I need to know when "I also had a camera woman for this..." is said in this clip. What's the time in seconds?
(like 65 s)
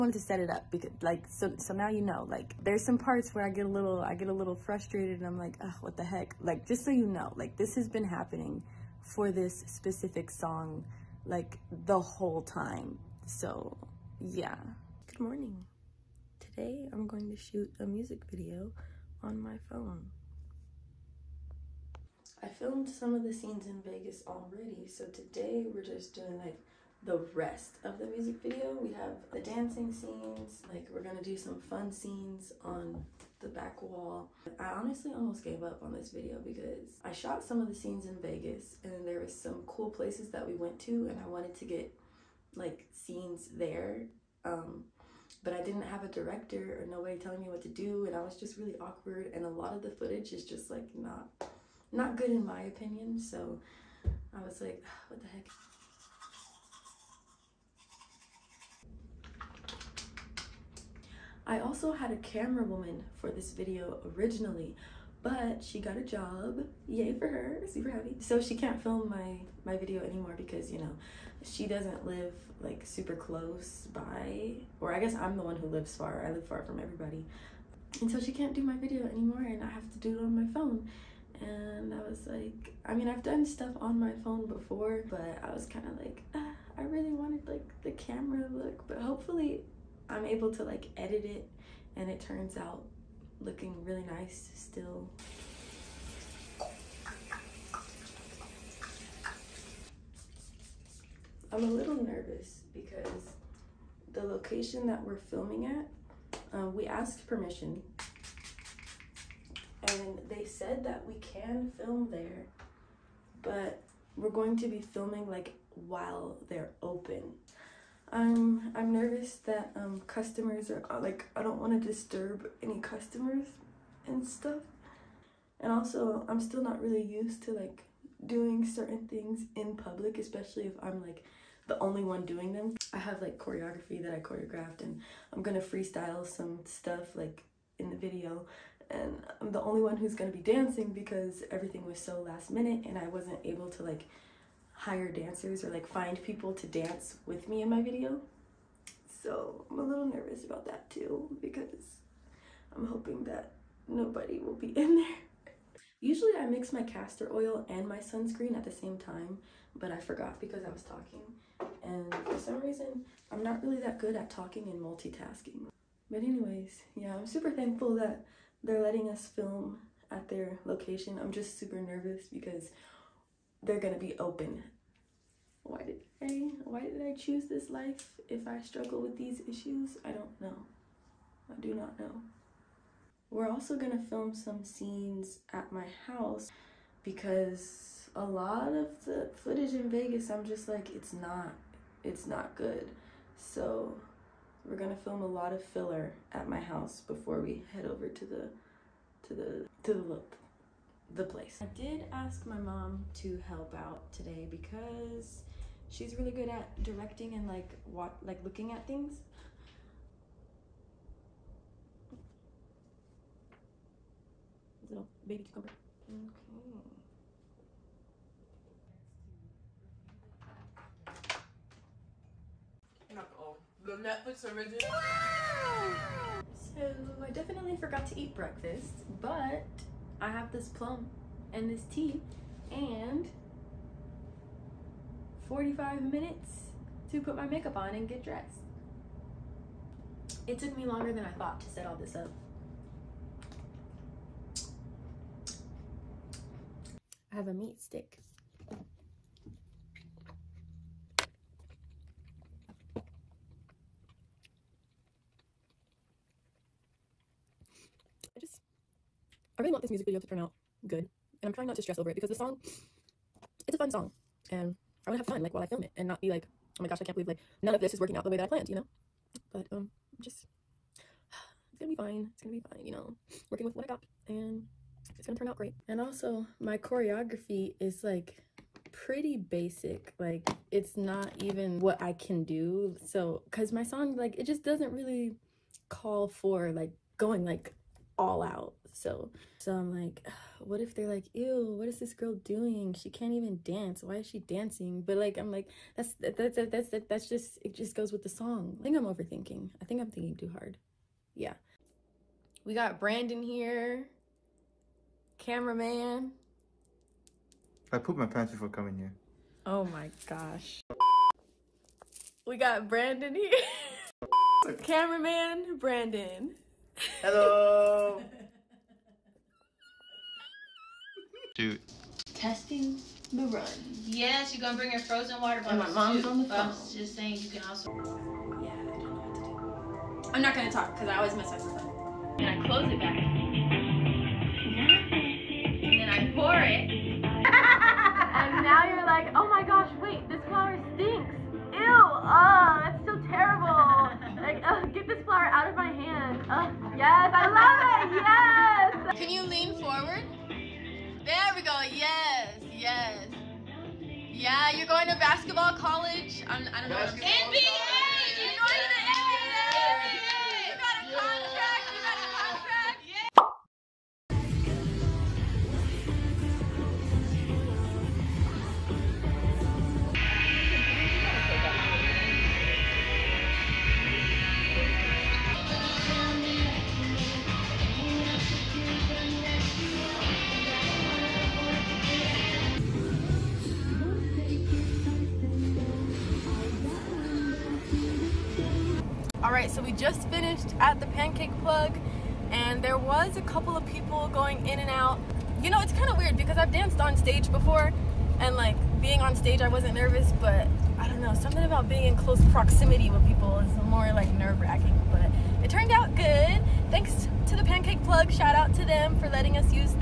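61 s.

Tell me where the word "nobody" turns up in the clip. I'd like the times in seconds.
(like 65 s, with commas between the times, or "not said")
46 s, 153 s.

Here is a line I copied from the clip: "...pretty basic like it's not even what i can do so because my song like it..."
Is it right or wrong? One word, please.
right.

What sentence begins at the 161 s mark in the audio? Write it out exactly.
And for some reason, I'm not really that good at talking and multitasking.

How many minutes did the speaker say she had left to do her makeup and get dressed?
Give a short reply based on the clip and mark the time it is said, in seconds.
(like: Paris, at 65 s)
45, at 235 s.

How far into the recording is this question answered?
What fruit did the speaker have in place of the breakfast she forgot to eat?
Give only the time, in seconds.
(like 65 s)
230 s.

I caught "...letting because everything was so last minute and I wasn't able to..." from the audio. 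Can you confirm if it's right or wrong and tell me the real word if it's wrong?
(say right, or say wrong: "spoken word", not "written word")
wrong: "dancing", not "letting".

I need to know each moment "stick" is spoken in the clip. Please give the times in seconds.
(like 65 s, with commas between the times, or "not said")
247 s.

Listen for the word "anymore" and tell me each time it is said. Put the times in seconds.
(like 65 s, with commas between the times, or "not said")
70 s, 79 s.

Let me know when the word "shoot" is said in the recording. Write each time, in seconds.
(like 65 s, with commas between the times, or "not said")
17 s.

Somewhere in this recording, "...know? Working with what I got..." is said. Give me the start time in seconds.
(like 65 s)
272 s.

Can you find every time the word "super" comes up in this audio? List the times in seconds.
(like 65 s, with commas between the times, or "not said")
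67 s, 72 s, 167 s, 171 s.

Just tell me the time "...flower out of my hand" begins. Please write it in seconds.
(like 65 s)
345 s.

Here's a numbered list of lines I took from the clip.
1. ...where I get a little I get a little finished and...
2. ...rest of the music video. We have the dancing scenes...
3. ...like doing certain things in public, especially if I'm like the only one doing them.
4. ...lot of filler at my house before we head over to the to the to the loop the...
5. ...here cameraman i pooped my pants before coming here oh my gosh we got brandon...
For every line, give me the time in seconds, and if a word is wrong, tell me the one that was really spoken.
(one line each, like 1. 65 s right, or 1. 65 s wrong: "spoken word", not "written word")
1. 3 s wrong: "frustrated", not "finished"
2. 27 s right
3. 127 s right
4. 195 s right
5. 303 s right.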